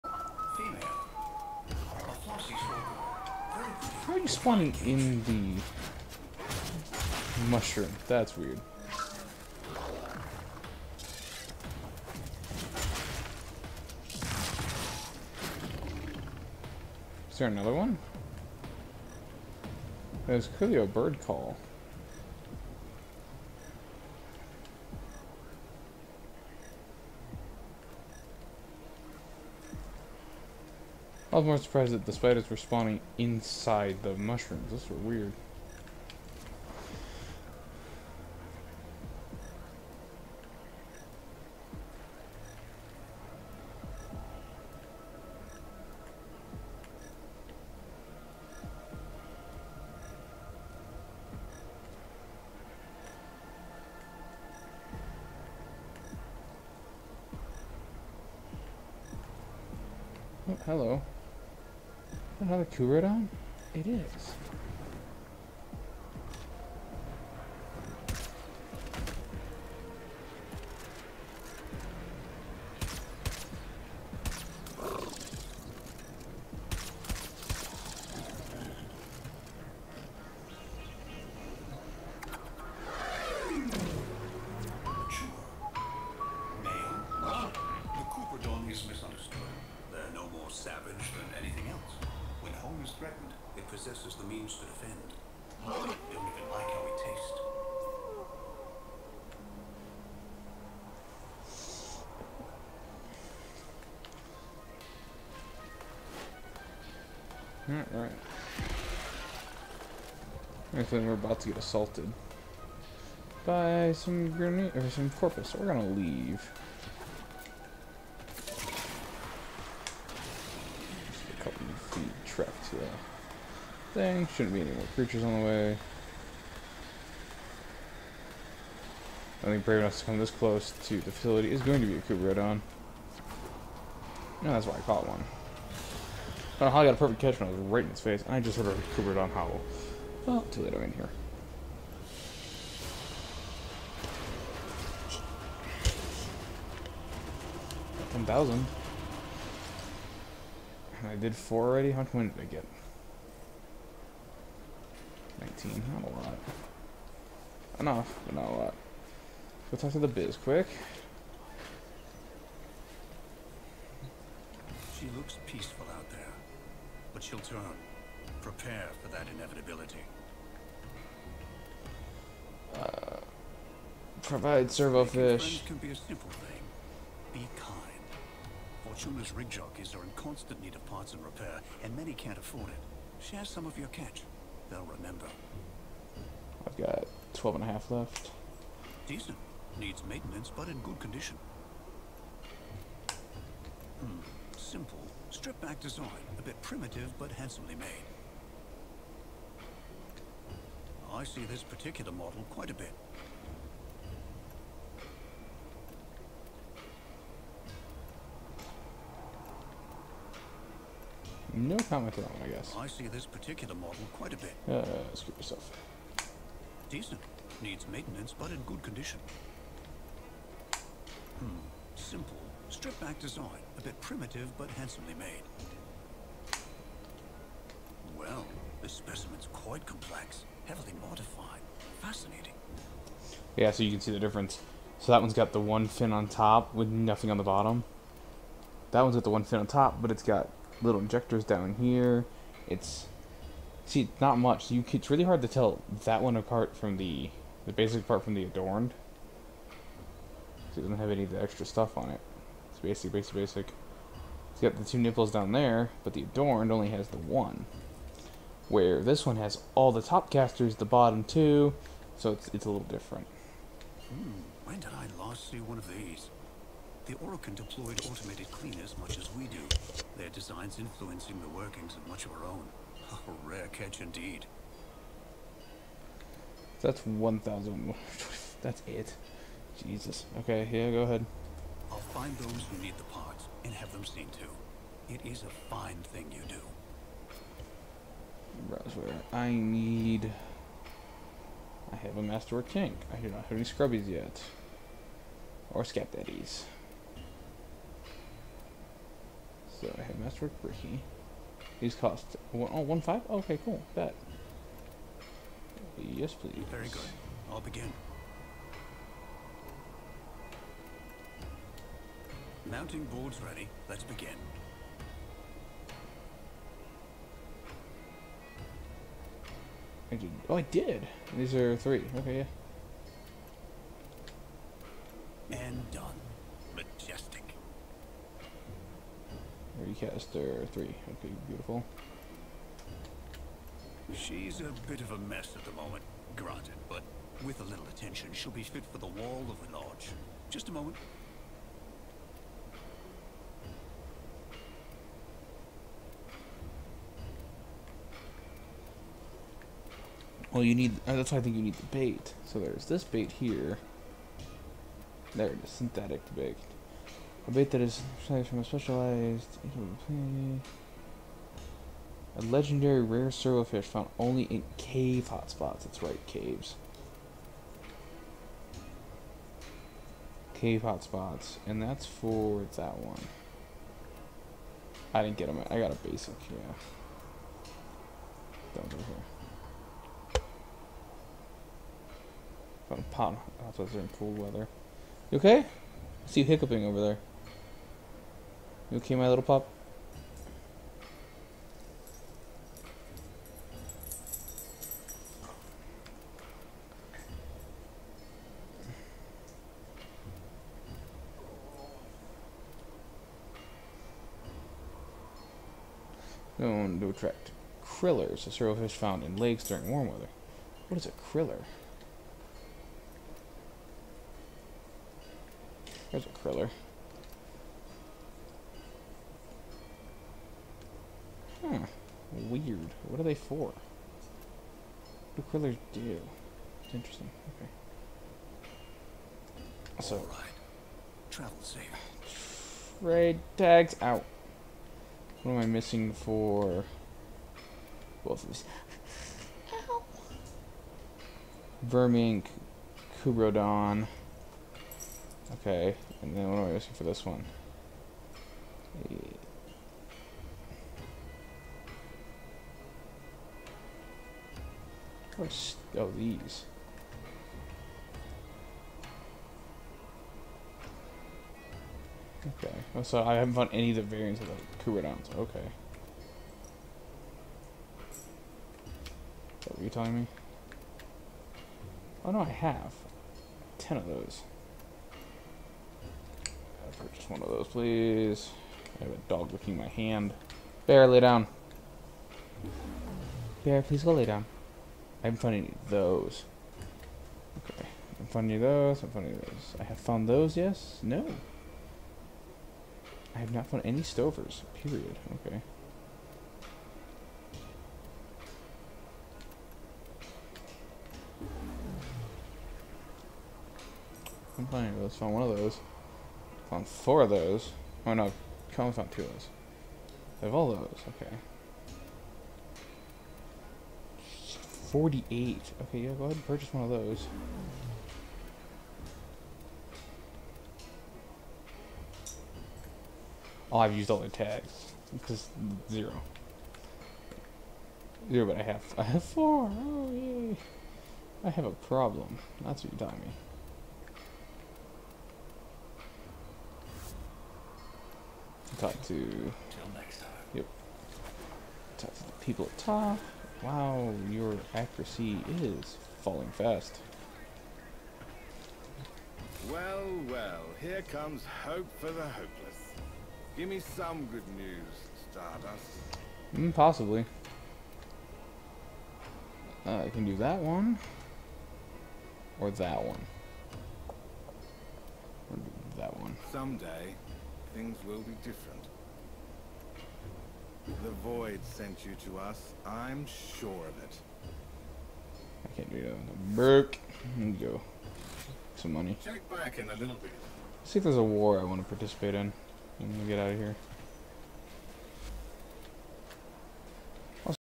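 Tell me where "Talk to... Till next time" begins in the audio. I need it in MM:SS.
08:58.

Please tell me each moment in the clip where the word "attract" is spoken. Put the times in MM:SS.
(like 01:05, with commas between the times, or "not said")
06:47.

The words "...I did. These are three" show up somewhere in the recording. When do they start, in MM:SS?
05:20.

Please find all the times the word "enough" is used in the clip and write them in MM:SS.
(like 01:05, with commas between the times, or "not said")
02:09, 02:37.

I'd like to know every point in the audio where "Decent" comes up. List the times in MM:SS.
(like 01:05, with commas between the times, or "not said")
03:09, 03:36.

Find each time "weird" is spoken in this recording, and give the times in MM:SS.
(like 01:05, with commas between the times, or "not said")
00:08, 00:34, 07:02.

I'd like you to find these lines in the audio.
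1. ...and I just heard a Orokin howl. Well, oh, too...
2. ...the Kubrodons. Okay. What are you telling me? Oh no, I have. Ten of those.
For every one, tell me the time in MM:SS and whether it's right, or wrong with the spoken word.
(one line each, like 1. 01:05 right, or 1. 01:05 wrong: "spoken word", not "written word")
1. 02:18 wrong: "Kubrodon", not "Orokin"
2. 07:44 right.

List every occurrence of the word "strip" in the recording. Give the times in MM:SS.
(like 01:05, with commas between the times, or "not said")
03:15, 03:42.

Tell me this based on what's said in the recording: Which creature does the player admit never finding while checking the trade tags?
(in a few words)
Stovers.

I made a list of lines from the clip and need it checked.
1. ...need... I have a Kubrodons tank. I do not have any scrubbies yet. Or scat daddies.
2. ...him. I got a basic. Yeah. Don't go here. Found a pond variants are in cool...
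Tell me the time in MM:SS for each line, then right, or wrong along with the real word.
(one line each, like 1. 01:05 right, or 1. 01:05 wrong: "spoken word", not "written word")
1. 04:49 wrong: "Masterwork", not "Kubrodons"
2. 06:15 wrong: "hotspots", not "variants".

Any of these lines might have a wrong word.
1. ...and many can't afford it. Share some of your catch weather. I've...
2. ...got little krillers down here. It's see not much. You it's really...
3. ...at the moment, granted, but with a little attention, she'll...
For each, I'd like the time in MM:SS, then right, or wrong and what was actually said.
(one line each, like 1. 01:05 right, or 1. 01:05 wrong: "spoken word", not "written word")
1. 03:01 wrong: "remember", not "weather"
2. 04:00 wrong: "injectors", not "krillers"
3. 05:35 right.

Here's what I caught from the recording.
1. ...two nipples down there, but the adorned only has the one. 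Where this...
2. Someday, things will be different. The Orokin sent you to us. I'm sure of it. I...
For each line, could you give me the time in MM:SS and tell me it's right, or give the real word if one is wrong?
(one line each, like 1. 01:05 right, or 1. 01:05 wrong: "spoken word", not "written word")
1. 04:14 right
2. 09:26 wrong: "Void", not "Orokin".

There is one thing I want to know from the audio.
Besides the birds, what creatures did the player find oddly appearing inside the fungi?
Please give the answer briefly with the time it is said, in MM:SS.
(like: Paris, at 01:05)
Spiders, at 00:32.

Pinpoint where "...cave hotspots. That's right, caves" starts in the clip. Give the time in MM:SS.
06:04.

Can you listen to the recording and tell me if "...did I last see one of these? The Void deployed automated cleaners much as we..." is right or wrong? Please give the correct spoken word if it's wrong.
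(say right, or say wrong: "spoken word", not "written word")
wrong: "Orokin", not "Void".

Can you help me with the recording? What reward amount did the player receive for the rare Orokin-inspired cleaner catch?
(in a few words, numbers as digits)
1,000.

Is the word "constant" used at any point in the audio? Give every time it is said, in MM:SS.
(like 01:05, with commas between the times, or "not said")
03:00.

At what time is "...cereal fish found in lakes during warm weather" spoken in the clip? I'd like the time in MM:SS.
06:48.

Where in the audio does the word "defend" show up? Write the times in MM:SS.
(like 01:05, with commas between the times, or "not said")
01:34.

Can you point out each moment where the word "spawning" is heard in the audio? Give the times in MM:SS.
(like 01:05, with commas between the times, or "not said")
00:04, 00:32.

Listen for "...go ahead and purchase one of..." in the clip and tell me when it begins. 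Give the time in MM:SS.
08:36.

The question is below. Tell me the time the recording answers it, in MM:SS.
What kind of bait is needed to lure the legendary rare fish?
05:55.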